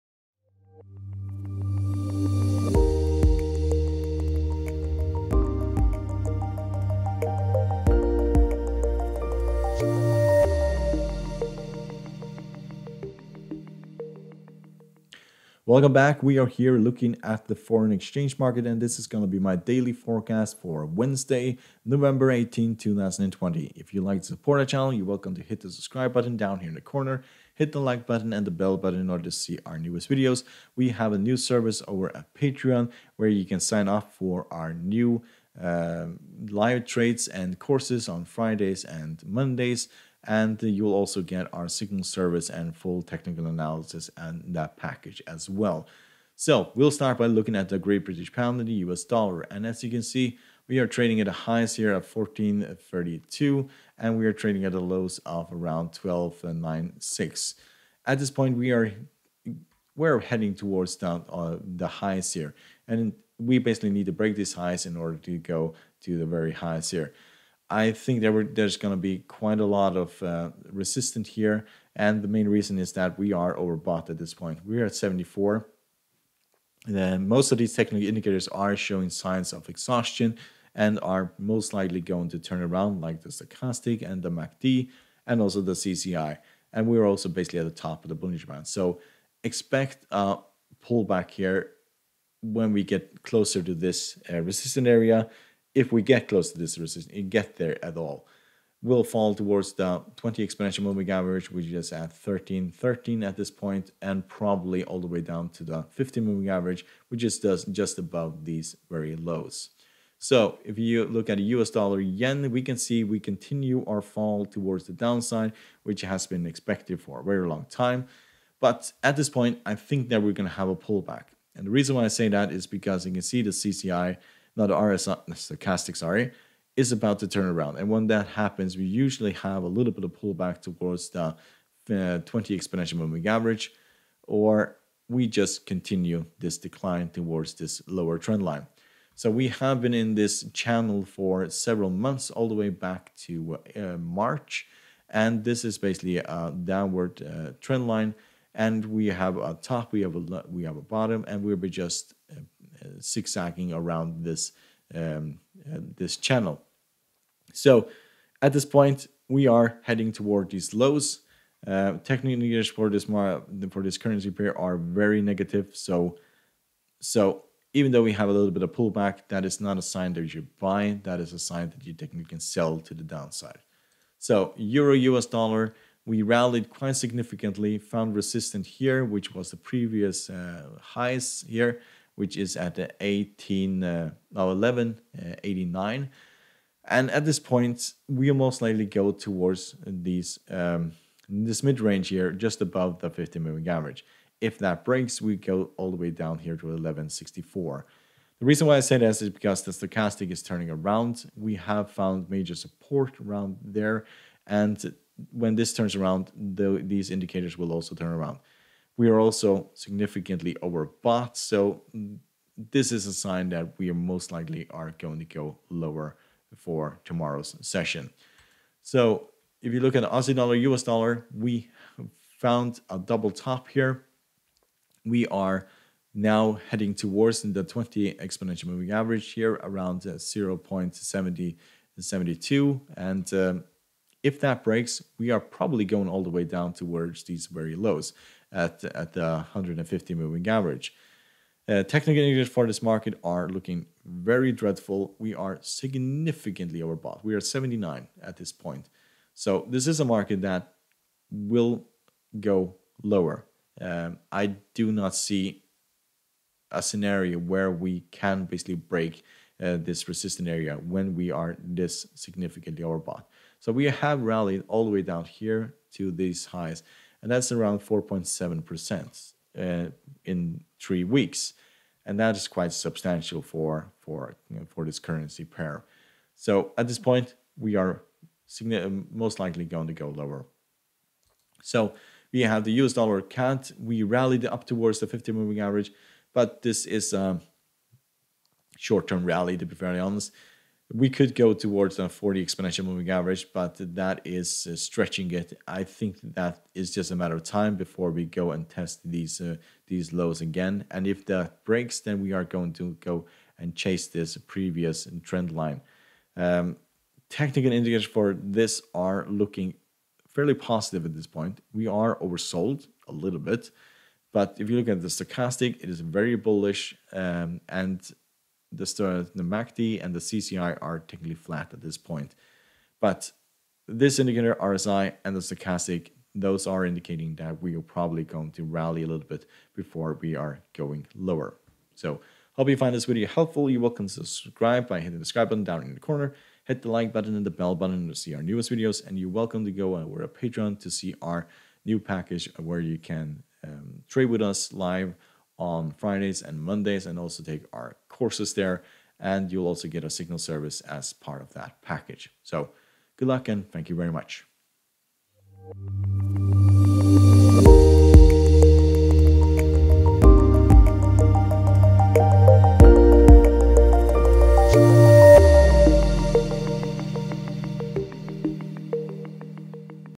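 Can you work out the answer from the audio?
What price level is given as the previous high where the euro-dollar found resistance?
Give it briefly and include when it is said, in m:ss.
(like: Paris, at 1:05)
1189, at 3:04.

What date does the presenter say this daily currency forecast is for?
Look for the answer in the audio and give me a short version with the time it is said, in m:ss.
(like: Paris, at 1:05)
Wednesday, November 18, 2020, at 0:20.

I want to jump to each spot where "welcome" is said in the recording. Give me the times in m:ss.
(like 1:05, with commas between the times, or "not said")
0:15, 0:25, 5:39.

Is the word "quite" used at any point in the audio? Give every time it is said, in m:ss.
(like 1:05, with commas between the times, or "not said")
1:09, 2:56, 4:32.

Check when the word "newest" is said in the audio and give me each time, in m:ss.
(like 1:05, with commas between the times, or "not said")
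0:29, 5:38.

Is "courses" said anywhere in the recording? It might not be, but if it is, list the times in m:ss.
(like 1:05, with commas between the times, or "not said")
0:37, 5:48.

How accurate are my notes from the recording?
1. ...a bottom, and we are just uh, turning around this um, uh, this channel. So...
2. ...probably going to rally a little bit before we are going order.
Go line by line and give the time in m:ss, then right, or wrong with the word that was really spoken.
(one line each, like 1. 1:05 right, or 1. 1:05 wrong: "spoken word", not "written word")
1. 2:30 wrong: "zigzagging", not "turning"
2. 5:27 wrong: "lower", not "order".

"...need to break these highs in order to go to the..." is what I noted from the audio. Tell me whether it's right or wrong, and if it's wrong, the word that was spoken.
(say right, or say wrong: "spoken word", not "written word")
right.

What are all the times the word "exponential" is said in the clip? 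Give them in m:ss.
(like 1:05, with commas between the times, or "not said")
1:40, 2:12, 3:48, 4:52.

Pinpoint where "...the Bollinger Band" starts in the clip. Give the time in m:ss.
1:28.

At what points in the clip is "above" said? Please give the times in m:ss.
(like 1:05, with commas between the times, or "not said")
1:47, 3:12.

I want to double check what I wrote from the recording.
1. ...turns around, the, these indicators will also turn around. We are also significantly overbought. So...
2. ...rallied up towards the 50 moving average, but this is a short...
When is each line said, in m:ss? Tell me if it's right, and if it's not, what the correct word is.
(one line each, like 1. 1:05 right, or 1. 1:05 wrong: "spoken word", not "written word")
1. 3:25 right
2. 4:44 right.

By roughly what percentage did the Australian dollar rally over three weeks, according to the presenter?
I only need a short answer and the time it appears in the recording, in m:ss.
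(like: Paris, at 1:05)
4.7%, at 4:27.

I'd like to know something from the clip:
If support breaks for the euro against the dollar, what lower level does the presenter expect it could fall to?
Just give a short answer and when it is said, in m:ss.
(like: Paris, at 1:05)
1164, at 3:16.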